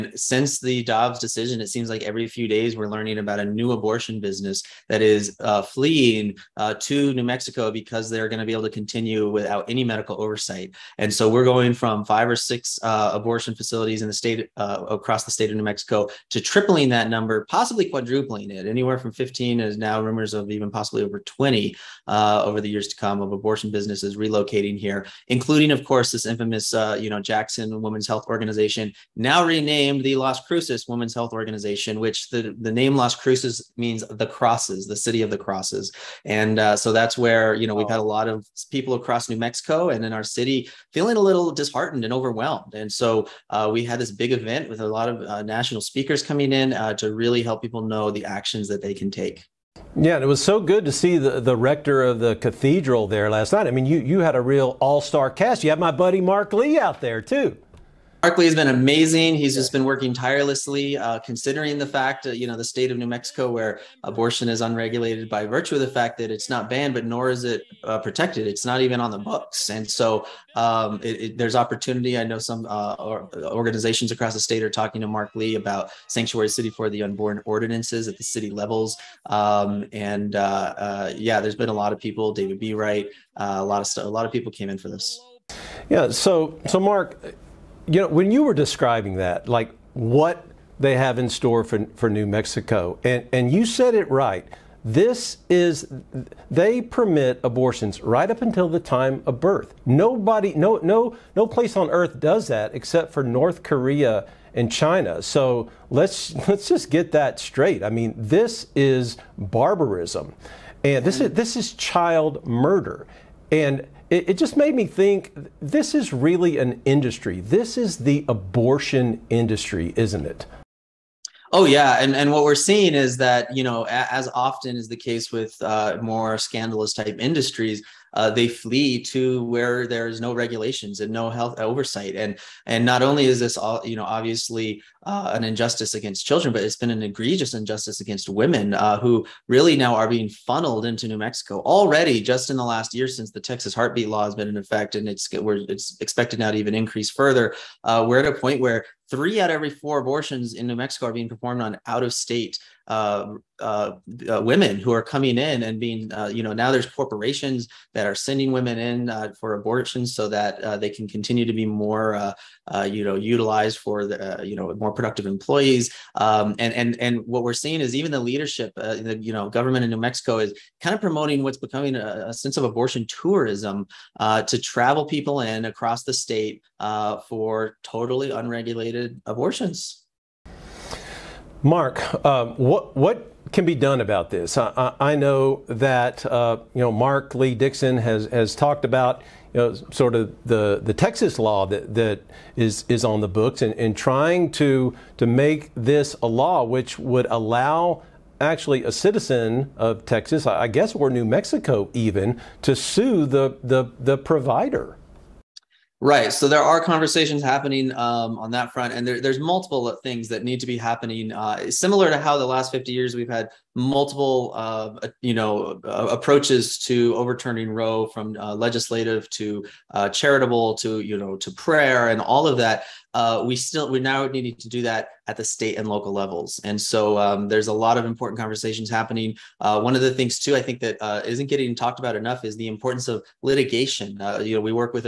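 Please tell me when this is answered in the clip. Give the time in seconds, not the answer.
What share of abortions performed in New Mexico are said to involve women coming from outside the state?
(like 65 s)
149 s.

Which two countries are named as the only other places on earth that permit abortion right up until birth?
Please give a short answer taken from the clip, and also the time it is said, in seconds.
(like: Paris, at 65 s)
North Korea and China, at 103 s.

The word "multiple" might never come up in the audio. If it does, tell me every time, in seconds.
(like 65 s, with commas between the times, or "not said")
209 s, 213 s.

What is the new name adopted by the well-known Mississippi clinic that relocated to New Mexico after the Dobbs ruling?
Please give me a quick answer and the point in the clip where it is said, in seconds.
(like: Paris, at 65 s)
Las Cruces Women's Health Organization, at 30 s.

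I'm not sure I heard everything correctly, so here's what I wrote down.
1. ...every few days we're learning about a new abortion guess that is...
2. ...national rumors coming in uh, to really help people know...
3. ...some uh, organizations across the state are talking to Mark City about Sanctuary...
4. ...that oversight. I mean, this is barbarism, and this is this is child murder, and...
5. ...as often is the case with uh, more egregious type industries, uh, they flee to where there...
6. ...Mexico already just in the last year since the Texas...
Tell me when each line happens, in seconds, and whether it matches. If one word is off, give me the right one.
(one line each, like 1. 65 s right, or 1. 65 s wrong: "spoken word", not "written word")
1. 2 s wrong: "business", not "guess"
2. 45 s wrong: "speakers", not "rumors"
3. 72 s wrong: "Lee", not "City"
4. 107 s wrong: "straight", not "oversight"
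5. 123 s wrong: "scandalous", not "egregious"
6. 141 s right.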